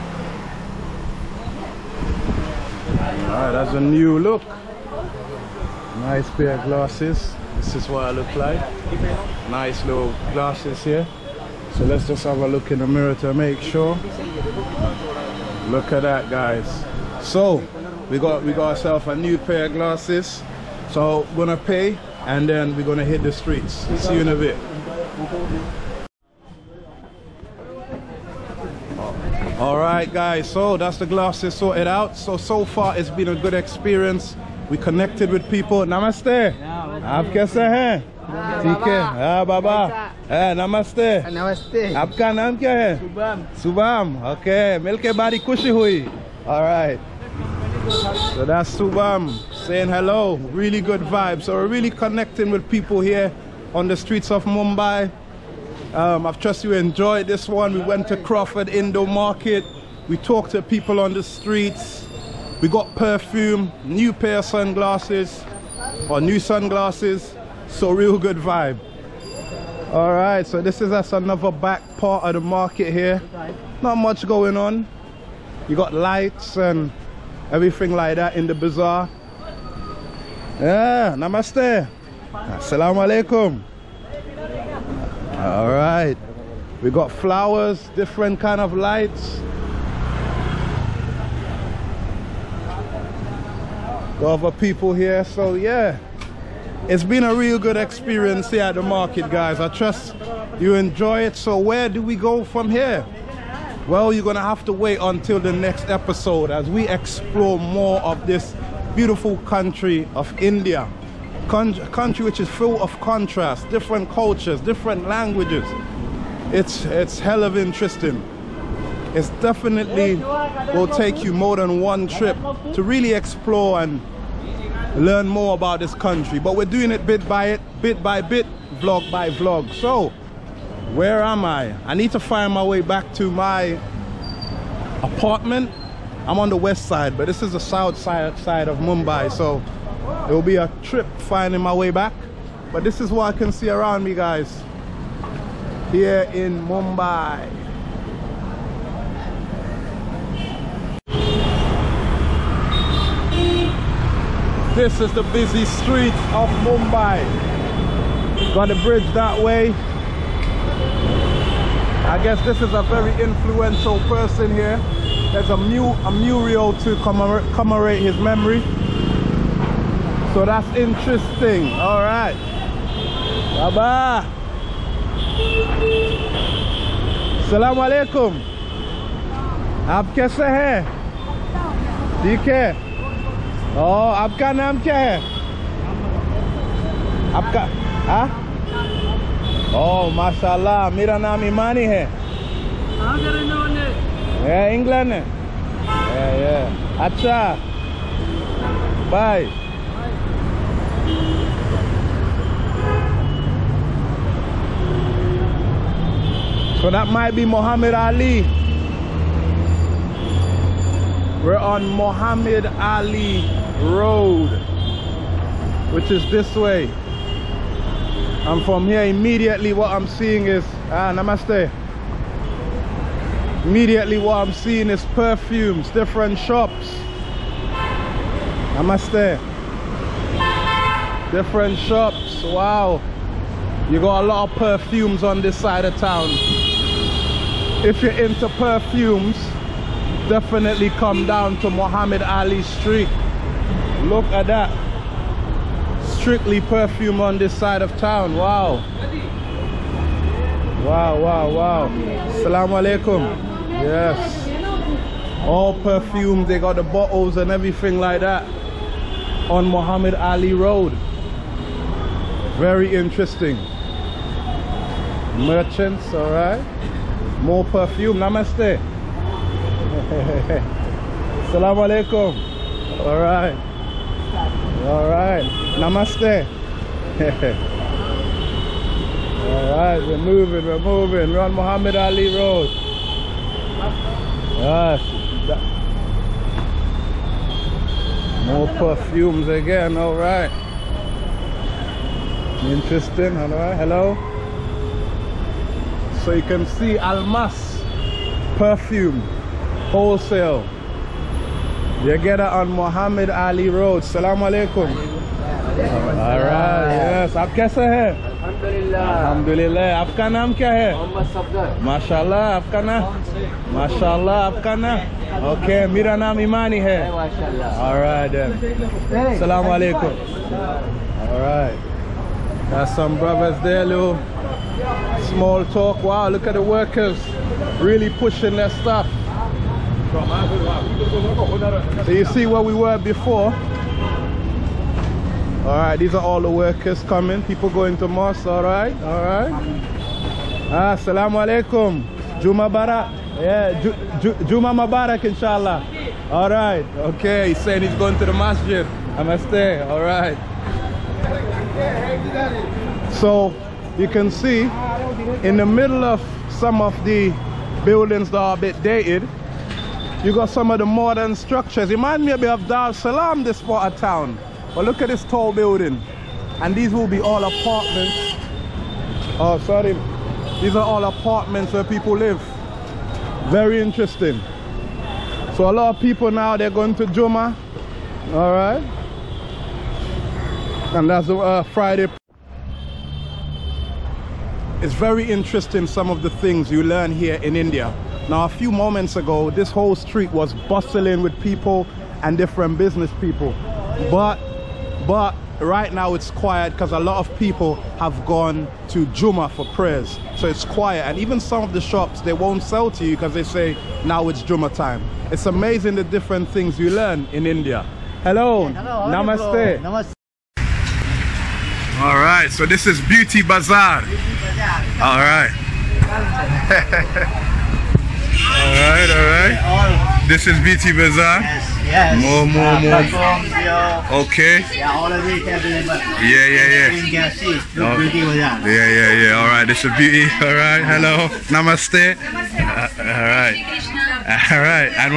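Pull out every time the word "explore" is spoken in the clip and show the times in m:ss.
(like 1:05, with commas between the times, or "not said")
1:46, 2:03.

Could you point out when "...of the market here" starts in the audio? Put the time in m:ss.
1:12.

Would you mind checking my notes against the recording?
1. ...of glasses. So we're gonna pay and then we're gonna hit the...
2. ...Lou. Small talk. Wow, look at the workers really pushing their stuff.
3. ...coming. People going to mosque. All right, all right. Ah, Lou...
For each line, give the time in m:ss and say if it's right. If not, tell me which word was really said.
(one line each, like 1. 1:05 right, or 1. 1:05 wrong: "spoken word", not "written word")
1. 0:19 right
2. 5:23 right
3. 5:37 wrong: "Assalamu", not "Lou".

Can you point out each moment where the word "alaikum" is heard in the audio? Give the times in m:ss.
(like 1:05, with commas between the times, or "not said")
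1:23, 4:12, 4:31, 5:04, 5:19, 5:41.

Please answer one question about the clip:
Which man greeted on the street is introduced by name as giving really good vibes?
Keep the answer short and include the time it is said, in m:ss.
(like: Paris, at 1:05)
Subam, at 0:48.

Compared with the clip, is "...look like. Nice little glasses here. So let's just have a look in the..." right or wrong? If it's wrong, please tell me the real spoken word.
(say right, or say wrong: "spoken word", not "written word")
right.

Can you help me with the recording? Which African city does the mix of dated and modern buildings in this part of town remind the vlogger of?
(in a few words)
Dar es Salaam.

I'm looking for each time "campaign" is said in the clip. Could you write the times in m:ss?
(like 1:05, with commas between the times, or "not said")
not said.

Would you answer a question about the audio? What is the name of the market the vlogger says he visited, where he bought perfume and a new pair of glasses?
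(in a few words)
Crawford Indo Market.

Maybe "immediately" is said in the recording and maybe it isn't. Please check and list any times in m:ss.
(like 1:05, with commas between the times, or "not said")
3:39, 3:43.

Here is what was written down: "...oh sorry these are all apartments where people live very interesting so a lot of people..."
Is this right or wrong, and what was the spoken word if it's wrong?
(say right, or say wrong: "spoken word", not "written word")
right.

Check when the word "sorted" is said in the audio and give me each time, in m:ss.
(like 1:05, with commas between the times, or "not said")
0:31.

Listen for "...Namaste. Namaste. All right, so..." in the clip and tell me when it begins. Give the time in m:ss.
6:49.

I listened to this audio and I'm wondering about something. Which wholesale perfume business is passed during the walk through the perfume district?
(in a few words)
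Almas perfume.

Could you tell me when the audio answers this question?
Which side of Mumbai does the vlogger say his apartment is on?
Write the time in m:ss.
2:16.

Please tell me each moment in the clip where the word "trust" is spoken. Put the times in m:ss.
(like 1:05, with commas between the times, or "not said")
0:56, 1:39.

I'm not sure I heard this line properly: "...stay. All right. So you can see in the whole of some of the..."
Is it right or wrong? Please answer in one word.
wrong.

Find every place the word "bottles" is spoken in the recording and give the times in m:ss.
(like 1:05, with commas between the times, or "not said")
4:16.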